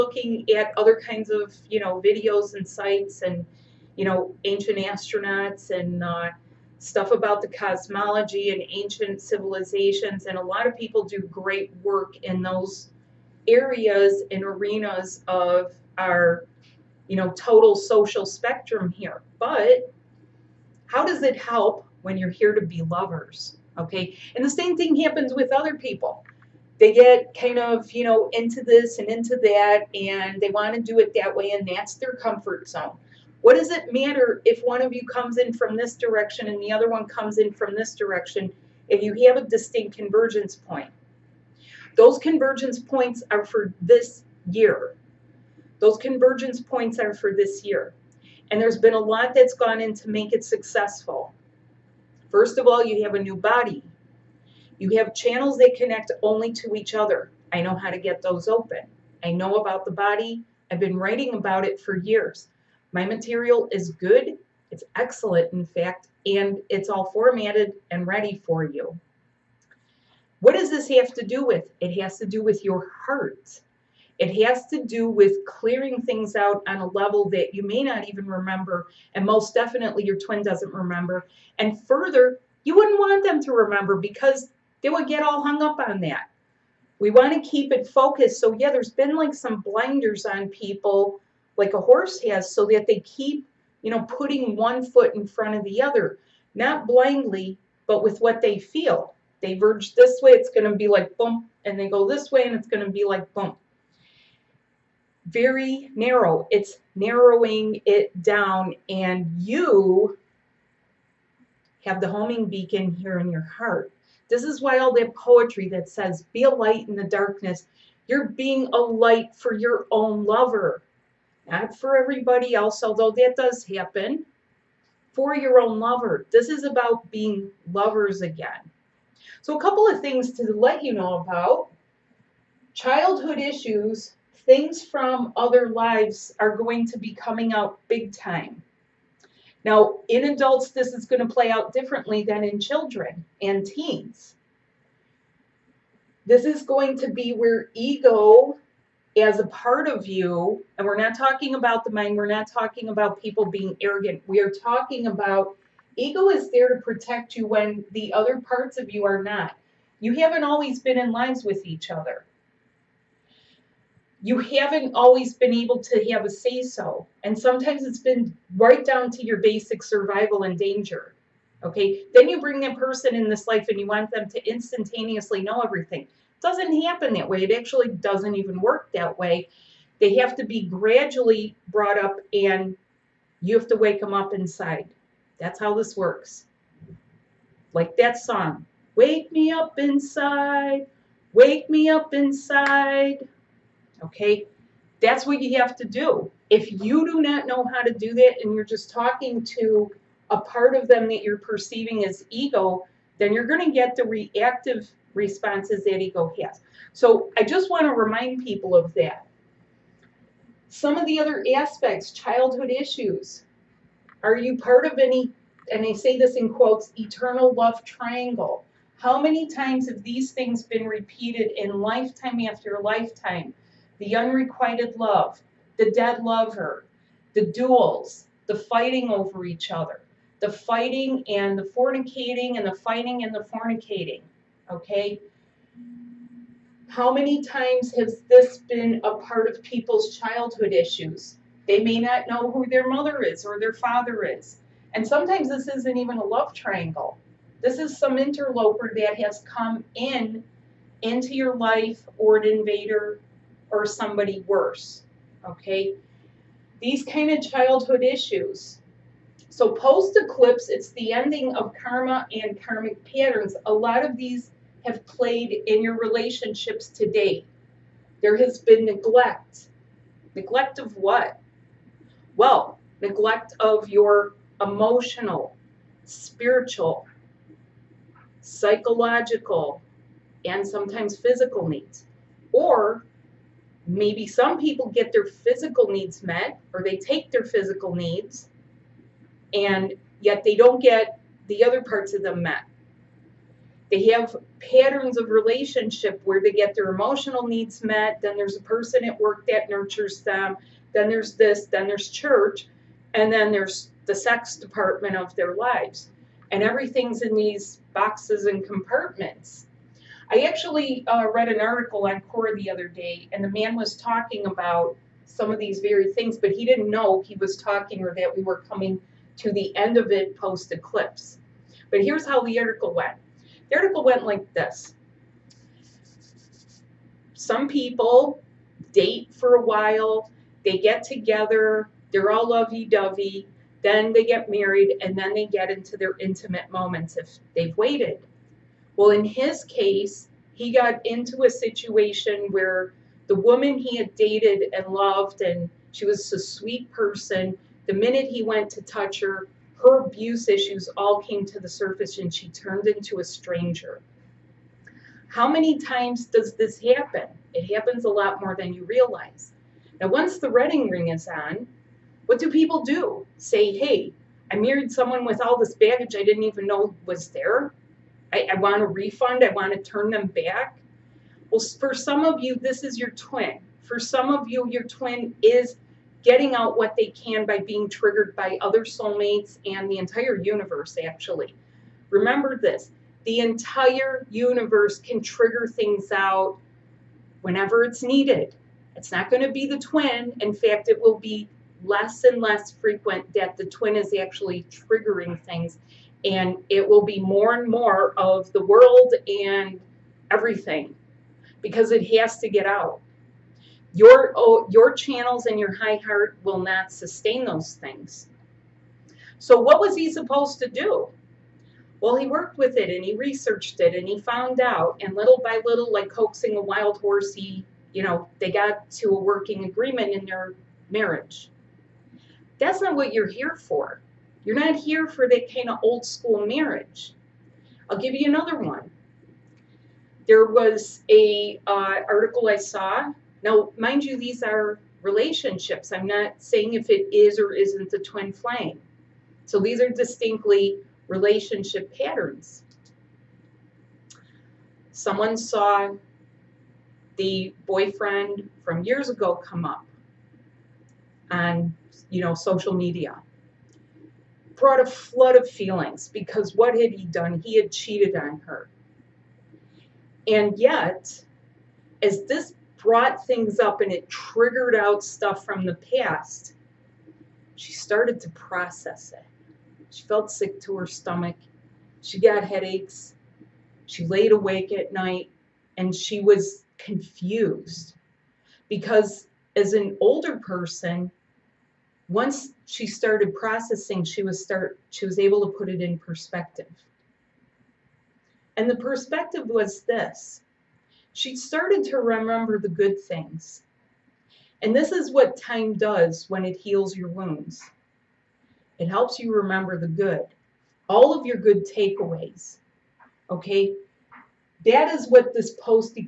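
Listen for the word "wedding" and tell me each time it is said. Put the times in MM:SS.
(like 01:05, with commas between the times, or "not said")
06:00.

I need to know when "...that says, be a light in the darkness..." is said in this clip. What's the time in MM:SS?
01:55.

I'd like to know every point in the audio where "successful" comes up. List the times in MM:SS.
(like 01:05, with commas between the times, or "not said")
00:50.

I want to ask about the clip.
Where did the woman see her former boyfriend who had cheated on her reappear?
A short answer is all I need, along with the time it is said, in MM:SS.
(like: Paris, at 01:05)
social media, at 07:32.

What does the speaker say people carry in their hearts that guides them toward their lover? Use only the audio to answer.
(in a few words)
homing beacon.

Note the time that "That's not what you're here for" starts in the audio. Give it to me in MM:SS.
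07:02.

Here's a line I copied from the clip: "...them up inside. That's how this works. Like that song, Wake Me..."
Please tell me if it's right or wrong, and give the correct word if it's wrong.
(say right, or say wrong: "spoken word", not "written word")
right.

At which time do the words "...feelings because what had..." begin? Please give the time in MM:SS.
07:35.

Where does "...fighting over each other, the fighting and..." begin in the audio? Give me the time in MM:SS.
03:48.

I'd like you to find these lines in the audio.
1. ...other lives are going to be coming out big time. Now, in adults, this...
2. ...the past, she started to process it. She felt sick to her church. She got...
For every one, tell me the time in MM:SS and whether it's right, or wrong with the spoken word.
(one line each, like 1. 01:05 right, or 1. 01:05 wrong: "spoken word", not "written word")
1. 02:15 right
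2. 07:45 wrong: "stomach", not "church".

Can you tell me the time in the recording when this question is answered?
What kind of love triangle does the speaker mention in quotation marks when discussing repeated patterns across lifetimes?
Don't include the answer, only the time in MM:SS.
03:36.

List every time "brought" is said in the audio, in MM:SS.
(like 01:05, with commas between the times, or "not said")
03:01, 07:34, 07:42.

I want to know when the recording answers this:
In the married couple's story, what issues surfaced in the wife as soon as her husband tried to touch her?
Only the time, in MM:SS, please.
05:50.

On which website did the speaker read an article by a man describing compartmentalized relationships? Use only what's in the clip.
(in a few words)
Quora.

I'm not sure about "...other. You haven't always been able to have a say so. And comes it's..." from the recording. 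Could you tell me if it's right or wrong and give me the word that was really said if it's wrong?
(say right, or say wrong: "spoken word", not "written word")
wrong: "sometimes", not "comes".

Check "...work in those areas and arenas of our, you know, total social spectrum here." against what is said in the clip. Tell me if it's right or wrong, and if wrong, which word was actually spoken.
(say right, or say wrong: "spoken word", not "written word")
right.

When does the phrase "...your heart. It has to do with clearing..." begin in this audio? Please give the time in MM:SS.
01:12.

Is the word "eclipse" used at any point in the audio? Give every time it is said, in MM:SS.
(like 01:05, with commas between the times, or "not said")
04:20, 05:20.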